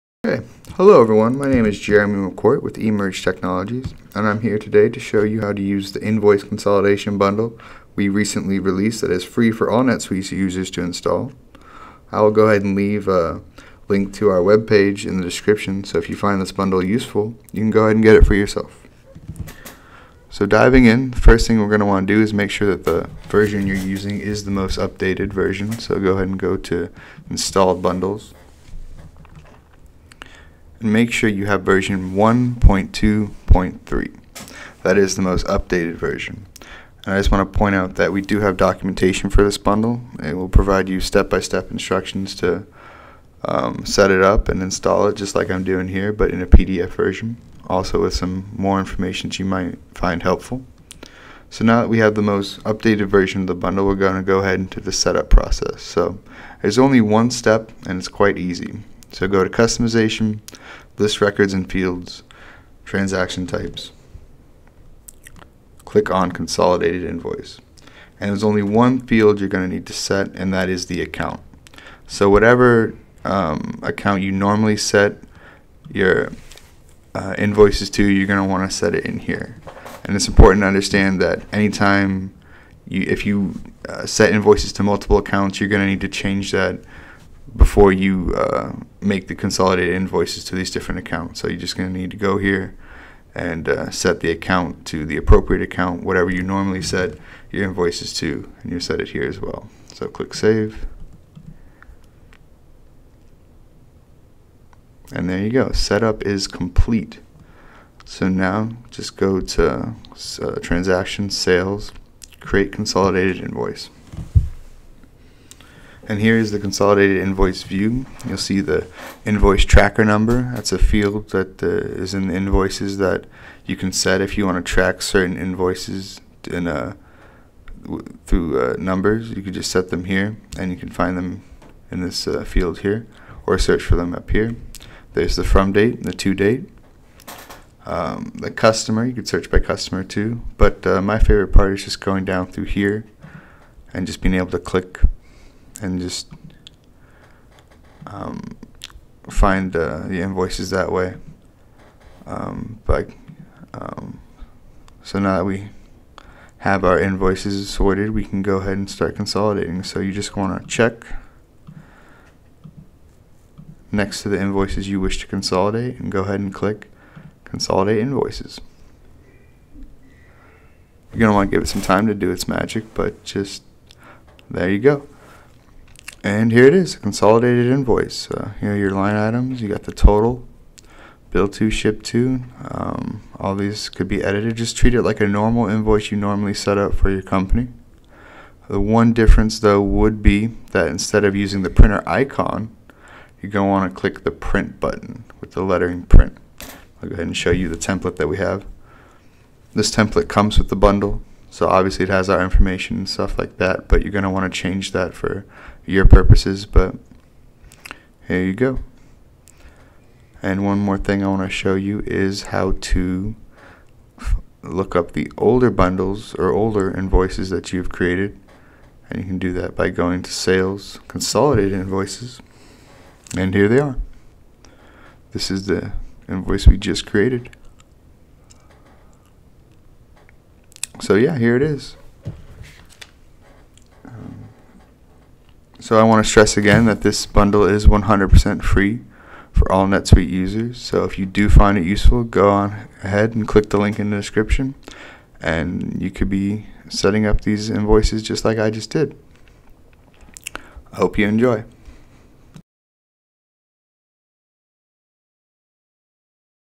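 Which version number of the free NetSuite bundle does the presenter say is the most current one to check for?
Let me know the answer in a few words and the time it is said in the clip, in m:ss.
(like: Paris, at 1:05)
1.2.3, at 0:32.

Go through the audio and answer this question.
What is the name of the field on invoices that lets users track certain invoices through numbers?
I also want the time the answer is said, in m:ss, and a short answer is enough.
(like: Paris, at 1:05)
invoice tracker number, at 1:59.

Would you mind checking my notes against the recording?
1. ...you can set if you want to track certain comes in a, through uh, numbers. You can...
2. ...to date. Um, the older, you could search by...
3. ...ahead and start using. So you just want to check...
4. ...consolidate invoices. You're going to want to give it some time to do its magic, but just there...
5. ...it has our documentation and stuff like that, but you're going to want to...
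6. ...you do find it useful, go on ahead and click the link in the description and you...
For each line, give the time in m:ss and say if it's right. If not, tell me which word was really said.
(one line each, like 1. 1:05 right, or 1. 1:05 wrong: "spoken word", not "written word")
1. 2:03 wrong: "invoices", not "comes"
2. 2:16 wrong: "customer", not "older"
3. 2:38 wrong: "consolidating", not "using"
4. 2:47 right
5. 3:22 wrong: "information", not "documentation"
6. 4:01 right.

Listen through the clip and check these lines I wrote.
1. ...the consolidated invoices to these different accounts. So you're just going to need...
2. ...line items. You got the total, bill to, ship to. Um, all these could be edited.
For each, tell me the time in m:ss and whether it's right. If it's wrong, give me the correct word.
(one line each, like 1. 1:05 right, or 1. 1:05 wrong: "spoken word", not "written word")
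1. 1:29 right
2. 2:58 right.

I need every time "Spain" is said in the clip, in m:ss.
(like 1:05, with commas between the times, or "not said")
not said.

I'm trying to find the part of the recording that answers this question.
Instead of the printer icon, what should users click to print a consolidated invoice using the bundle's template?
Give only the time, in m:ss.
3:14.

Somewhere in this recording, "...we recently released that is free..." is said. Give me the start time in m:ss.
0:07.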